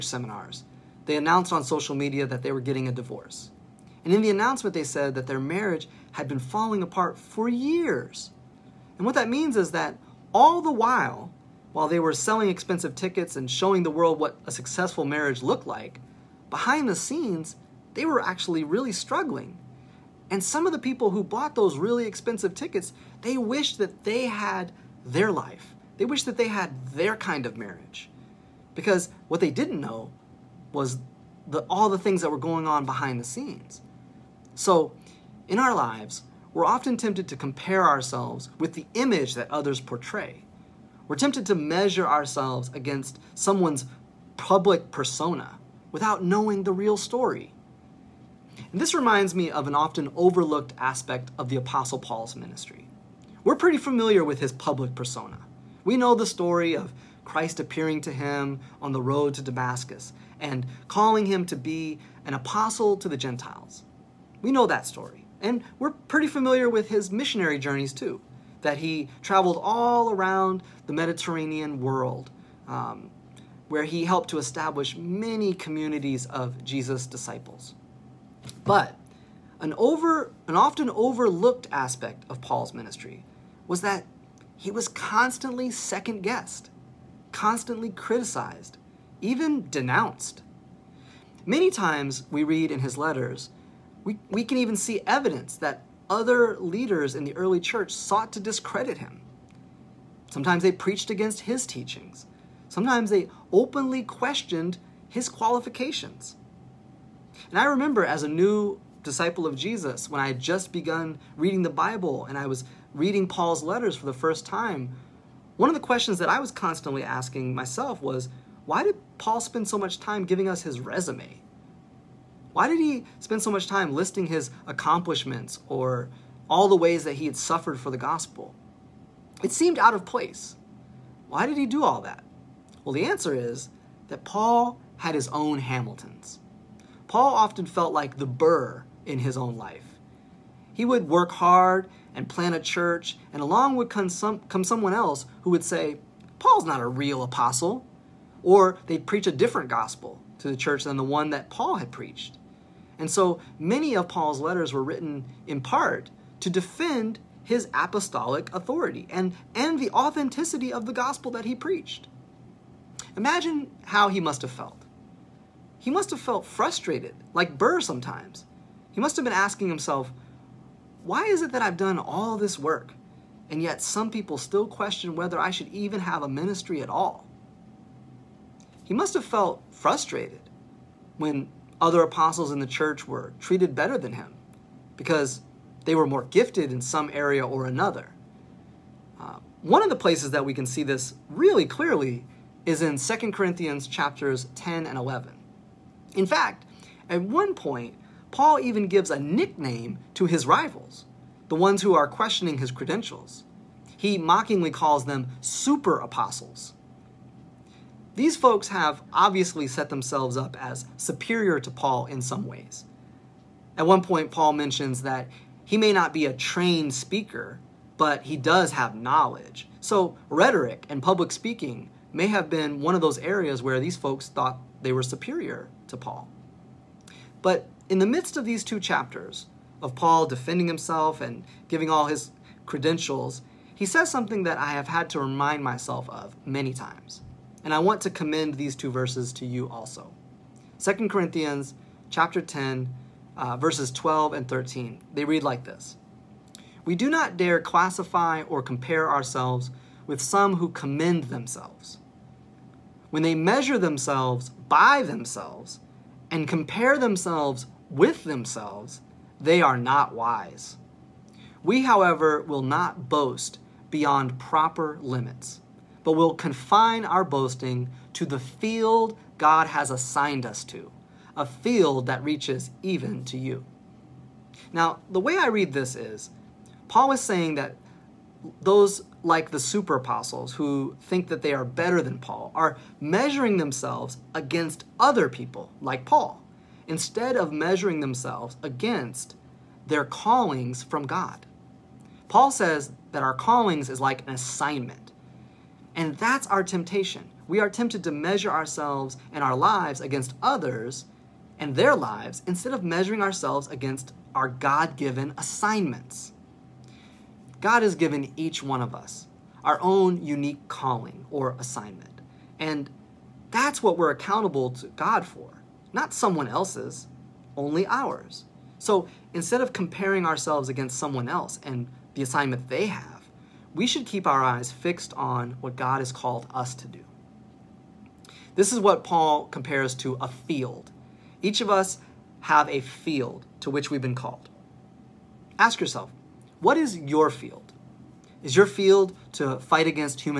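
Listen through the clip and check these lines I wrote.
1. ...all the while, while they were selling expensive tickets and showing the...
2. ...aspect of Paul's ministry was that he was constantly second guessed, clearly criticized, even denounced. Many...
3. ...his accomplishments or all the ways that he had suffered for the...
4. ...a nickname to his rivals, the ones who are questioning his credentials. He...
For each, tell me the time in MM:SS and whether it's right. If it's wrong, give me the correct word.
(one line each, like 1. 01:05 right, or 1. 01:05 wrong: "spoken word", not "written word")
1. 00:10 right
2. 01:21 wrong: "constantly", not "clearly"
3. 02:04 right
4. 03:19 right.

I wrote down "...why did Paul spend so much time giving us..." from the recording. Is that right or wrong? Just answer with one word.
right.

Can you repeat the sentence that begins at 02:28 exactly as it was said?
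Or they'd preach a different gospel to the church than the one that Paul had preached.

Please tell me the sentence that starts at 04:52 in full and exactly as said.
Paul says that our callings is like an assignment.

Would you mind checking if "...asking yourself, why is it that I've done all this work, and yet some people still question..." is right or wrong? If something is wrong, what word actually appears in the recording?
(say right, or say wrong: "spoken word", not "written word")
wrong: "himself", not "yourself".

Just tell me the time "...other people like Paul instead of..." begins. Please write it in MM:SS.
04:44.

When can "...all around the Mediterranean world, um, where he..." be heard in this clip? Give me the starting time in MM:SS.
01:09.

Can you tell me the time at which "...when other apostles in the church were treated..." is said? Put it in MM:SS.
03:01.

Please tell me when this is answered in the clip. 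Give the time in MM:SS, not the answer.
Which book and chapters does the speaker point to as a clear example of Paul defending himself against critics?
03:12.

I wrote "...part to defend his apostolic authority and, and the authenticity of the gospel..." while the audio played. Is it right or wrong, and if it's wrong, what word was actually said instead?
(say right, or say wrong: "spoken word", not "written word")
right.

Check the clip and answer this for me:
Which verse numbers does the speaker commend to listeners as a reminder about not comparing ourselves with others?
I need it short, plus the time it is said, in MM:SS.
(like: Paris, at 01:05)
12 and 13, at 04:03.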